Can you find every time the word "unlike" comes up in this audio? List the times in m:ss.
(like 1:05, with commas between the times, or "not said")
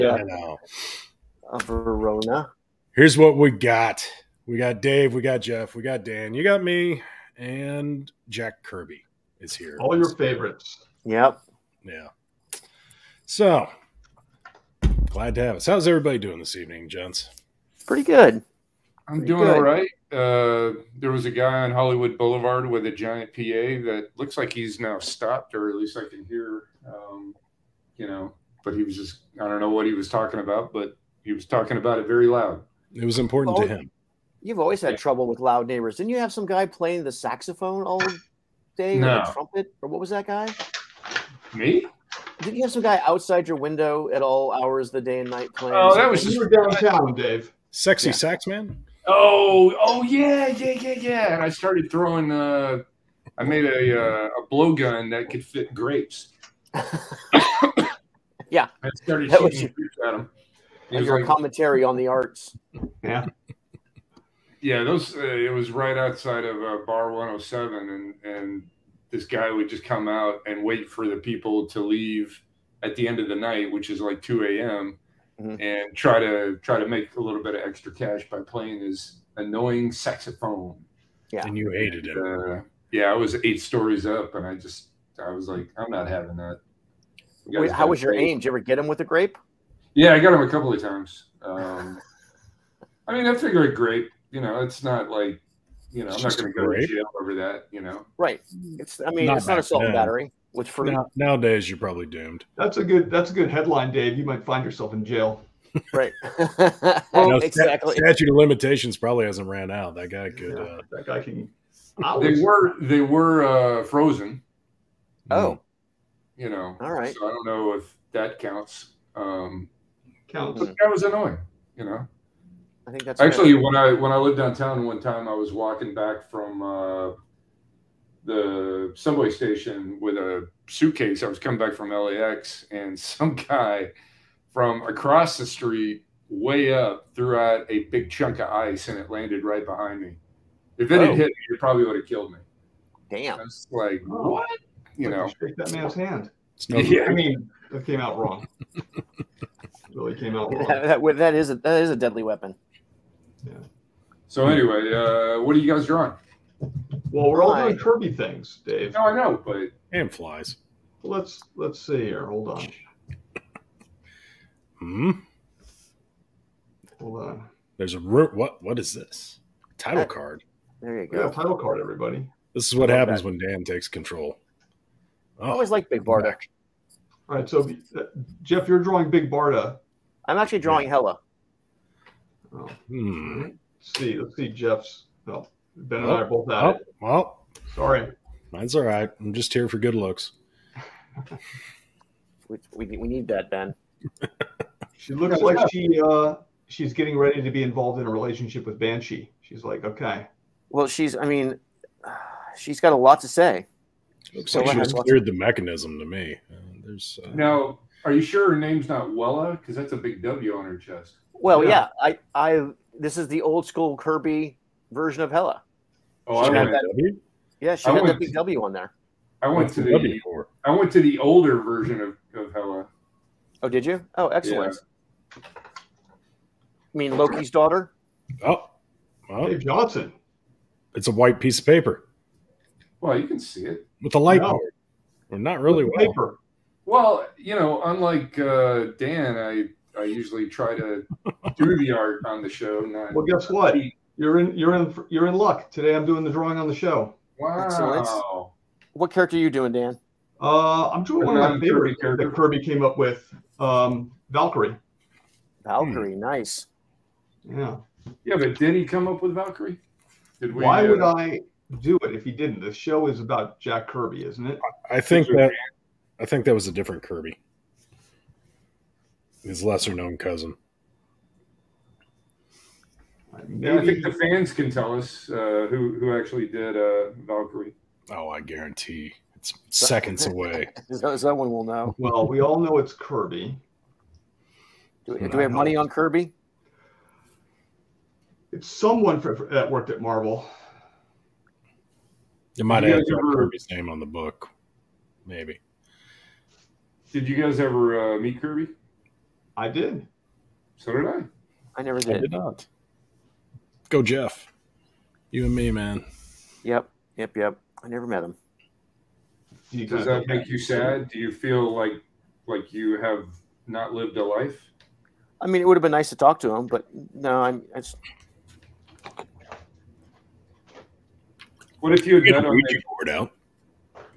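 3:57.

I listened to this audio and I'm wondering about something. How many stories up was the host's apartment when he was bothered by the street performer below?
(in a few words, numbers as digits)
8.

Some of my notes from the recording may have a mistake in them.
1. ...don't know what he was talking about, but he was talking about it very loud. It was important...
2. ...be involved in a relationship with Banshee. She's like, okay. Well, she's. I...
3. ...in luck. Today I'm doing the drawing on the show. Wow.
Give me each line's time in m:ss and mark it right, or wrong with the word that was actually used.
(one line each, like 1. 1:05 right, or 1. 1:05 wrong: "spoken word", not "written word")
1. 0:29 right
2. 3:17 right
3. 4:05 right.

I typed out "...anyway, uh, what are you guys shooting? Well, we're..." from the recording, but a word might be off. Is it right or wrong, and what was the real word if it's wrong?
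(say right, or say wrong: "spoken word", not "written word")
wrong: "drawing", not "shooting".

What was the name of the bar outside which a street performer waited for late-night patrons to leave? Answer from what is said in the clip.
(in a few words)
Bar 107.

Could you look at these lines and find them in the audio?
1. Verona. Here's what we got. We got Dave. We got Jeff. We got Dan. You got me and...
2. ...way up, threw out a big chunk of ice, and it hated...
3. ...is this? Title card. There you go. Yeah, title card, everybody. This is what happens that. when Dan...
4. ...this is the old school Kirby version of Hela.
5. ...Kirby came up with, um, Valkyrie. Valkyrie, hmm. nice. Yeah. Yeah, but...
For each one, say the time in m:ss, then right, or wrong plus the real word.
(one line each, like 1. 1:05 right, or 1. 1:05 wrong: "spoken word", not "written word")
1. 0:01 right
2. 2:16 wrong: "landed", not "hated"
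3. 2:48 right
4. 3:32 right
5. 4:12 right.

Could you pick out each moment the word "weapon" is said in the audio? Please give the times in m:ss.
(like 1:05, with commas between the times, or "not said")
2:32.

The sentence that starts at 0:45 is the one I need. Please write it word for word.
Oh, that was you were downtown, Dave.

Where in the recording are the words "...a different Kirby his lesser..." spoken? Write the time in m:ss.
4:26.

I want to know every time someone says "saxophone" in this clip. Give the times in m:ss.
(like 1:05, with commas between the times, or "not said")
0:37, 1:19.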